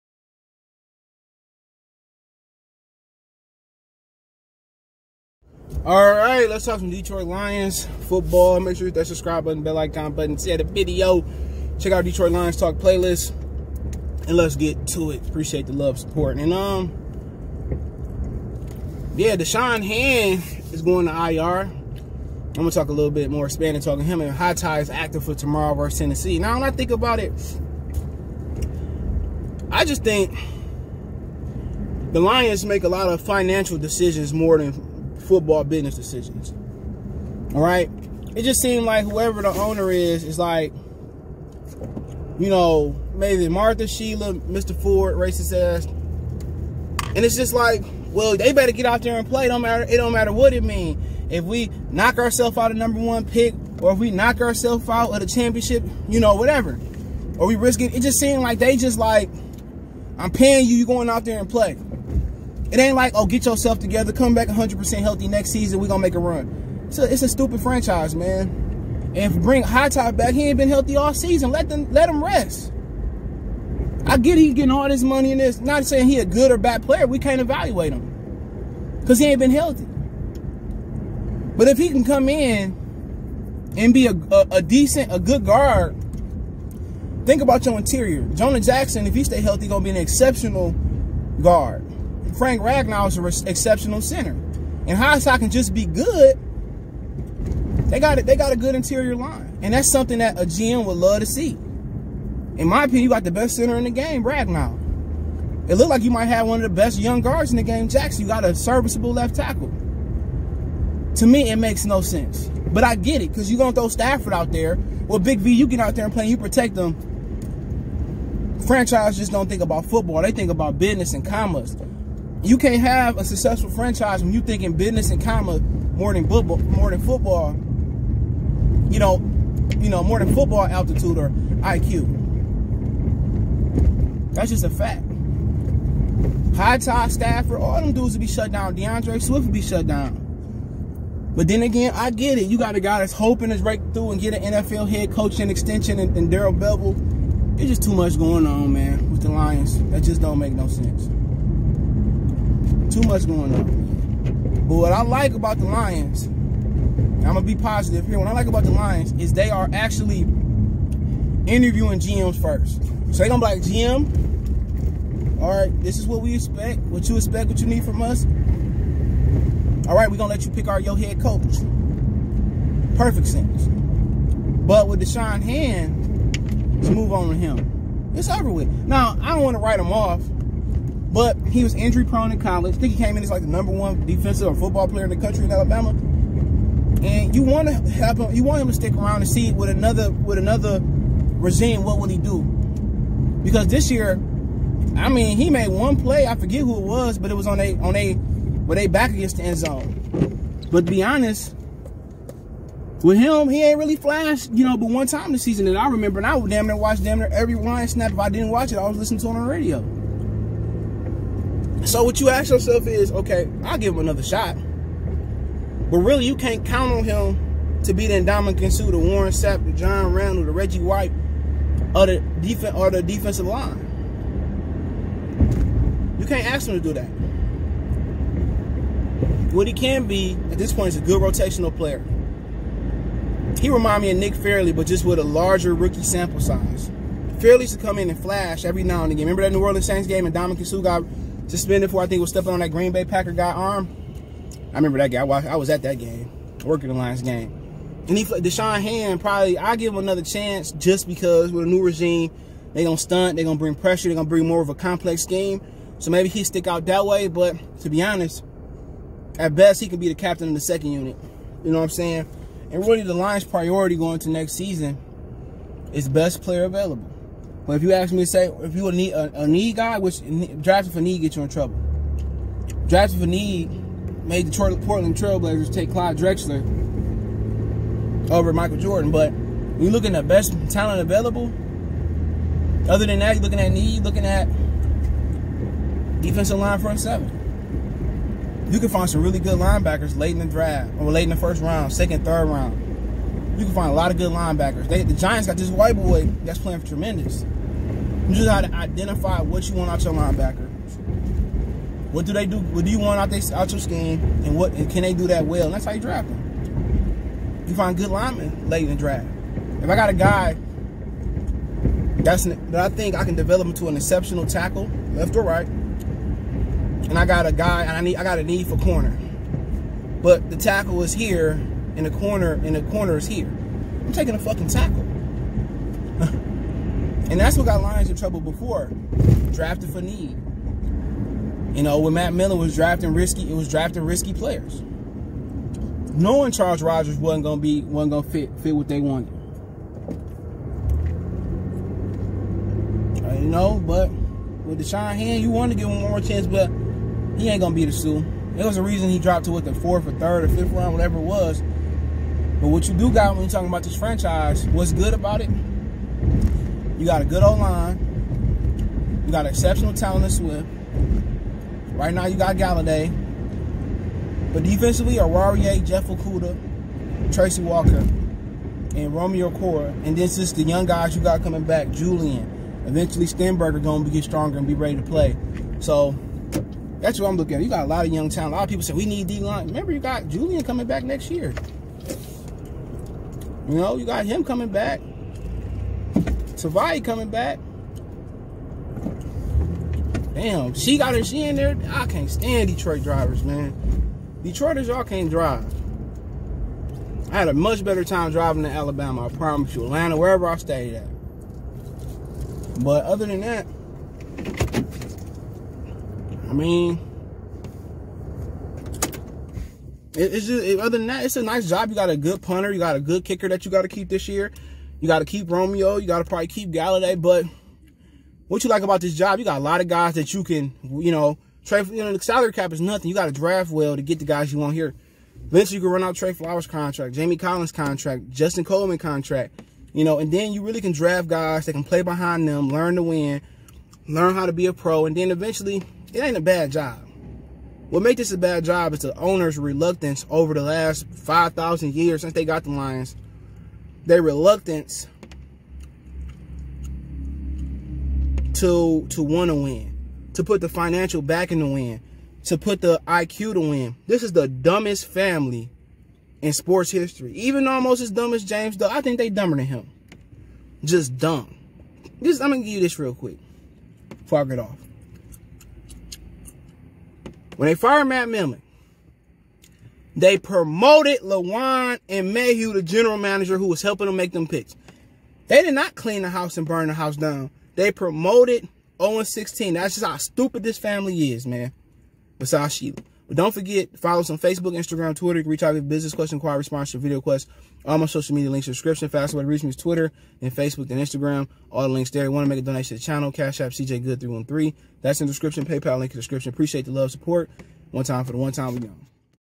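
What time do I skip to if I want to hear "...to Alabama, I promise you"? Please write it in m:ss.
6:38.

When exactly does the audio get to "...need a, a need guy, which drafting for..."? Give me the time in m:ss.
4:28.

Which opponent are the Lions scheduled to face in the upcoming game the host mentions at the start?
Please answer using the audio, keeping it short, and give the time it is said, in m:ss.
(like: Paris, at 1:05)
Tennessee, at 0:25.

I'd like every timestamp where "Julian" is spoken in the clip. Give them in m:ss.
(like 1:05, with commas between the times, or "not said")
6:11, 6:20.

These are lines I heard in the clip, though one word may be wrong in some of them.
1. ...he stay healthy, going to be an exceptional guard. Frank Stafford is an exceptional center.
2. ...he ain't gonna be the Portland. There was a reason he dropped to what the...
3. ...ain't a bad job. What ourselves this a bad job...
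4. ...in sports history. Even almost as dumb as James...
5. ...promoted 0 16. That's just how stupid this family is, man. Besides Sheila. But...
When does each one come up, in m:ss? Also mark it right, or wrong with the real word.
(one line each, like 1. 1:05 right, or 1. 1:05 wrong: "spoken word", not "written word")
1. 1:29 wrong: "Ragnow", not "Stafford"
2. 5:47 wrong: "Suh", not "Portland"
3. 7:16 wrong: "makes", not "ourselves"
4. 7:36 right
5. 7:57 right.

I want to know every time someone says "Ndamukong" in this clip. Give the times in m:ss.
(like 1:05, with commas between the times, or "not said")
3:38, 4:00.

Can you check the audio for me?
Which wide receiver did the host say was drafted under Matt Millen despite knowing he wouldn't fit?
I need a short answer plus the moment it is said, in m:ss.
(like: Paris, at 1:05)
Charles Rogers, at 5:36.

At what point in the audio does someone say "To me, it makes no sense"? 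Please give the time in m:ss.
1:51.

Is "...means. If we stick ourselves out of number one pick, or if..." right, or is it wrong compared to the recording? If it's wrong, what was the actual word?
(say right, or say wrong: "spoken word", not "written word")
wrong: "knock", not "stick".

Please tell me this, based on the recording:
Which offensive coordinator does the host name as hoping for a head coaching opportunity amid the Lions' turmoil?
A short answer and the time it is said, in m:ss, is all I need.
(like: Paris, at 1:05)
Darrell Bevell, at 2:26.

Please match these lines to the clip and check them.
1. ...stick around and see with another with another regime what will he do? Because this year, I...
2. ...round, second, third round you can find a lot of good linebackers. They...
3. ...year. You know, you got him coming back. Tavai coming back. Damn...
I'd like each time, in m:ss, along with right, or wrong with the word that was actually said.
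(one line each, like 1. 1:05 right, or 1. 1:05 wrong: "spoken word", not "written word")
1. 3:08 right
2. 4:51 right
3. 6:21 right.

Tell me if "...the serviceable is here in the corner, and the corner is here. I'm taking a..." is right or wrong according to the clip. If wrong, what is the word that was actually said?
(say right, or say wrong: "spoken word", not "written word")
wrong: "tackle", not "serviceable".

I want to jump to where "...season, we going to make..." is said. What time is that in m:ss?
1:05.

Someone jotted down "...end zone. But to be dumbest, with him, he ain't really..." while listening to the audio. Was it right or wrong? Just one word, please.
wrong.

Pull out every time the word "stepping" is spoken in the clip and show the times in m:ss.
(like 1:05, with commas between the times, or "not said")
4:02.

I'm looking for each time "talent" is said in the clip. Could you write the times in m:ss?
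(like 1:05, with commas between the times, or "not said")
4:40, 5:59, 6:18.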